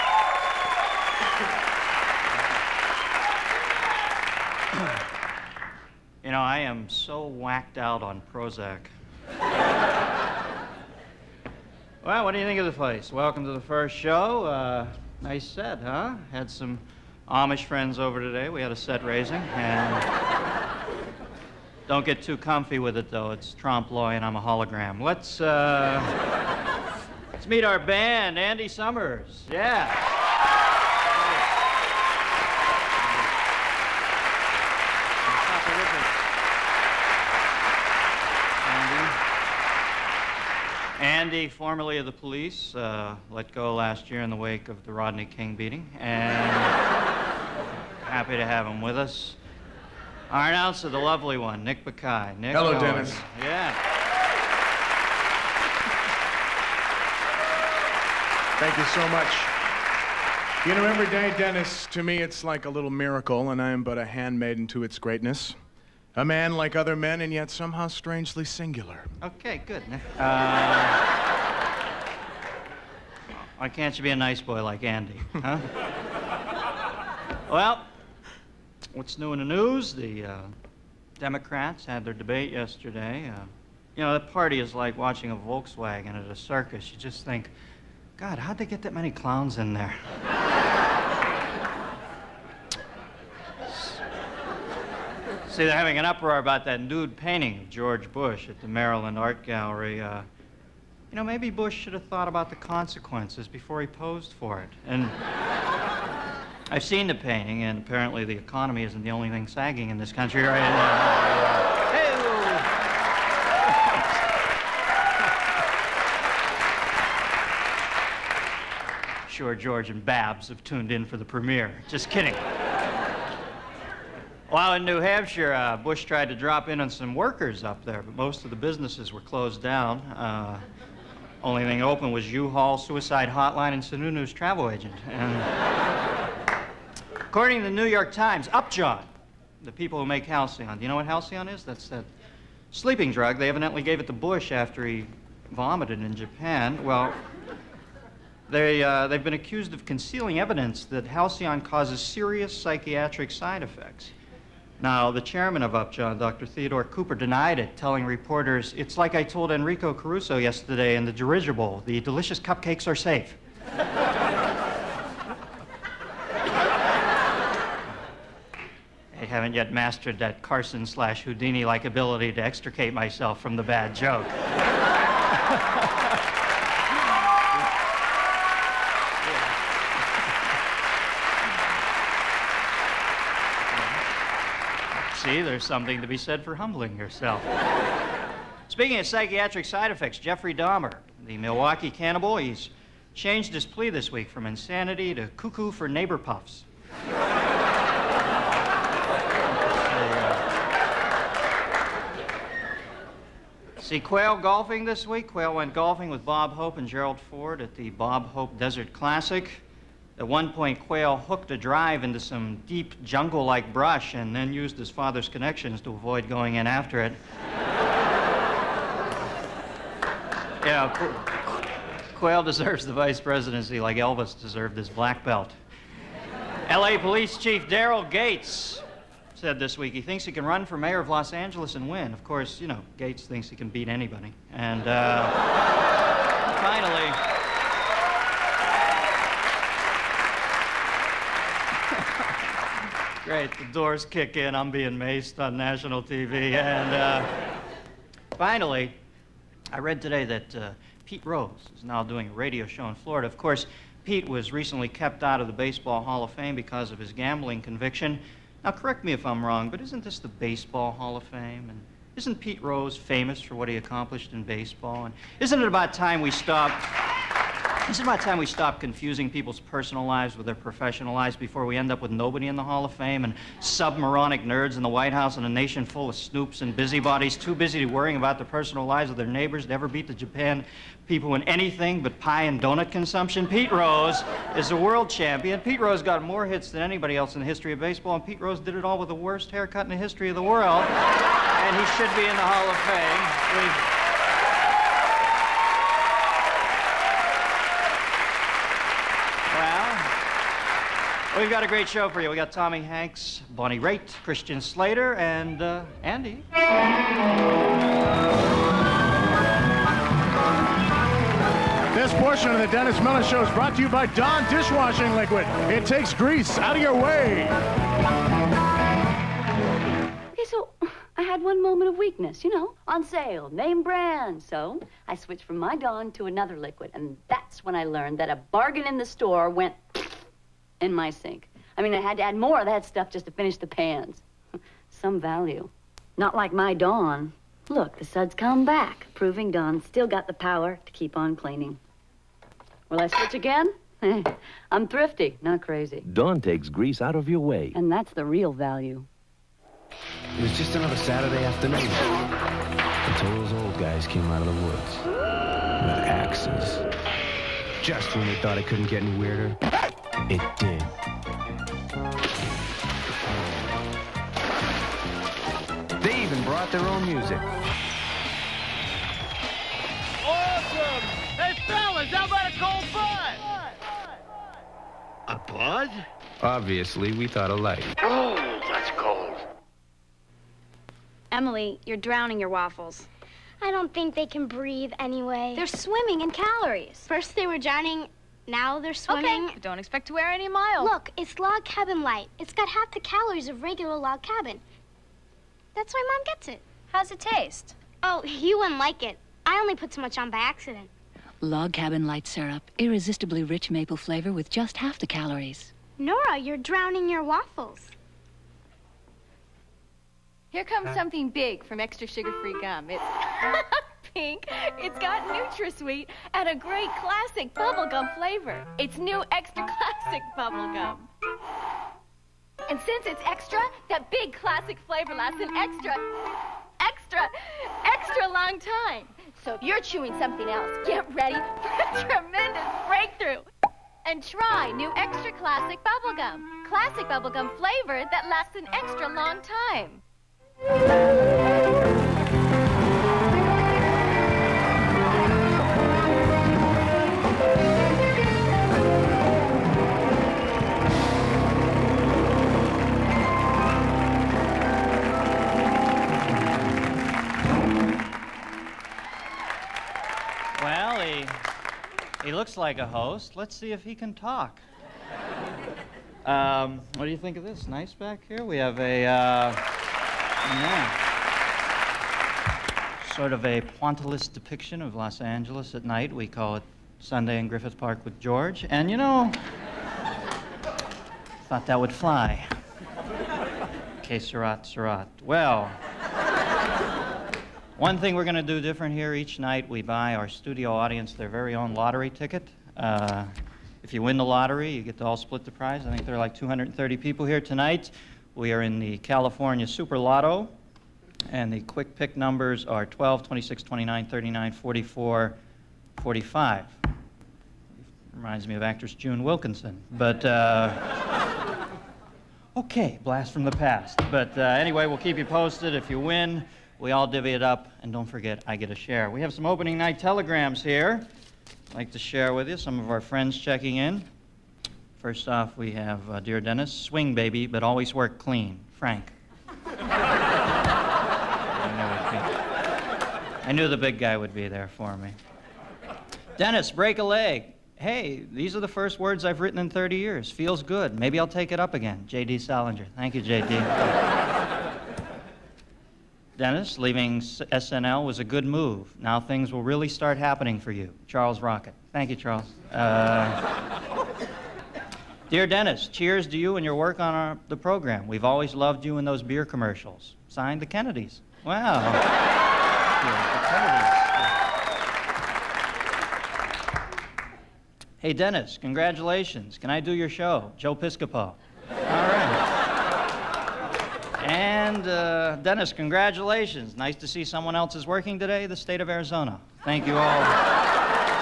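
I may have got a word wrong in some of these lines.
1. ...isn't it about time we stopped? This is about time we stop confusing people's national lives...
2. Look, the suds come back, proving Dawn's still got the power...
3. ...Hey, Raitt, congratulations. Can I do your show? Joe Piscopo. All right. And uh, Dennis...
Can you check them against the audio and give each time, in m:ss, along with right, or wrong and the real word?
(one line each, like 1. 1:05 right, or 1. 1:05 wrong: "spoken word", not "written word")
1. 4:25 wrong: "personal", not "national"
2. 5:37 right
3. 9:27 wrong: "Dennis", not "Raitt".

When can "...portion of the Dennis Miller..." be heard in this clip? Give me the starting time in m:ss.
5:12.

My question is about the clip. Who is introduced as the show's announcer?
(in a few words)
Nick Bakay.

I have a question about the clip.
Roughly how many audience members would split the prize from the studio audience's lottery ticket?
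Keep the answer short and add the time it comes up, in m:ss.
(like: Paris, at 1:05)
230, at 8:16.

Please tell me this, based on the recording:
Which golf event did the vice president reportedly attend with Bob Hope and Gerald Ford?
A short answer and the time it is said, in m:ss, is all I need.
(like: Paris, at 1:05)
Bob Hope Desert Classic, at 3:27.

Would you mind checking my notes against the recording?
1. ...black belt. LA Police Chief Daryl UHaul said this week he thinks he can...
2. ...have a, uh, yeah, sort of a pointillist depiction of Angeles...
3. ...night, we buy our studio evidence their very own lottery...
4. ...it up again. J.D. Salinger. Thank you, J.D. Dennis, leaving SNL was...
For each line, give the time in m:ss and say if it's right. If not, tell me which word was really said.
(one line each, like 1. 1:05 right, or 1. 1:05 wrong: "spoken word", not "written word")
1. 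3:44 wrong: "Gates", not "UHaul"
2. 7:48 wrong: "Los", not "Angeles"
3. 8:09 wrong: "audience", not "evidence"
4. 9:01 right.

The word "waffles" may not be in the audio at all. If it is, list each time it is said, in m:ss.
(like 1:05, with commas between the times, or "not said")
6:22, 6:47.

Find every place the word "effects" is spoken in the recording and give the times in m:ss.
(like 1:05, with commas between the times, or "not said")
2:33, 3:09.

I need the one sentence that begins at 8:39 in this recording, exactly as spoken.
We have some opening night telegrams here.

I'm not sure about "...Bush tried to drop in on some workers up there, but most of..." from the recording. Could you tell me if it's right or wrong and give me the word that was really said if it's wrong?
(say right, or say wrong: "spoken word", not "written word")
right.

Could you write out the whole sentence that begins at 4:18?
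Now, correct me if I'm wrong, but isn't this the Baseball Hall of Fame?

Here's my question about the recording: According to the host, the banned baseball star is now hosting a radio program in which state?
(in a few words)
Florida.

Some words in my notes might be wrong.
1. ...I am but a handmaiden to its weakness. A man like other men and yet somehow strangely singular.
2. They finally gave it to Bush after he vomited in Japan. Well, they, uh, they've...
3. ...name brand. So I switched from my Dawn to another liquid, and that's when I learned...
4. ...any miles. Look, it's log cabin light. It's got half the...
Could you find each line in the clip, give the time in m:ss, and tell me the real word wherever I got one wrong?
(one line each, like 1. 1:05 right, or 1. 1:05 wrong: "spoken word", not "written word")
1. 1:03 wrong: "greatness", not "weakness"
2. 2:23 wrong: "evidently", not "finally"
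3. 5:23 right
4. 6:30 right.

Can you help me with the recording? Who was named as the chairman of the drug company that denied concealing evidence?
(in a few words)
Dr. Theodore Cooper.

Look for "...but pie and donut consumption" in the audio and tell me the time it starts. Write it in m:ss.
4:42.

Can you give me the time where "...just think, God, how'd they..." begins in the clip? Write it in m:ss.
1:26.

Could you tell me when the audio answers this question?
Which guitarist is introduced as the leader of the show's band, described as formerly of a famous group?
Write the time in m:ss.
0:28.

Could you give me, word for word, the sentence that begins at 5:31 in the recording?
I mean, I had to add more of that stuff just to finish the pans.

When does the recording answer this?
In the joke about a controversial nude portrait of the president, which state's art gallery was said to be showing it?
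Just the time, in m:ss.
1:38.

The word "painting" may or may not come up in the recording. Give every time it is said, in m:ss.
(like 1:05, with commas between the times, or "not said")
1:37, 1:47.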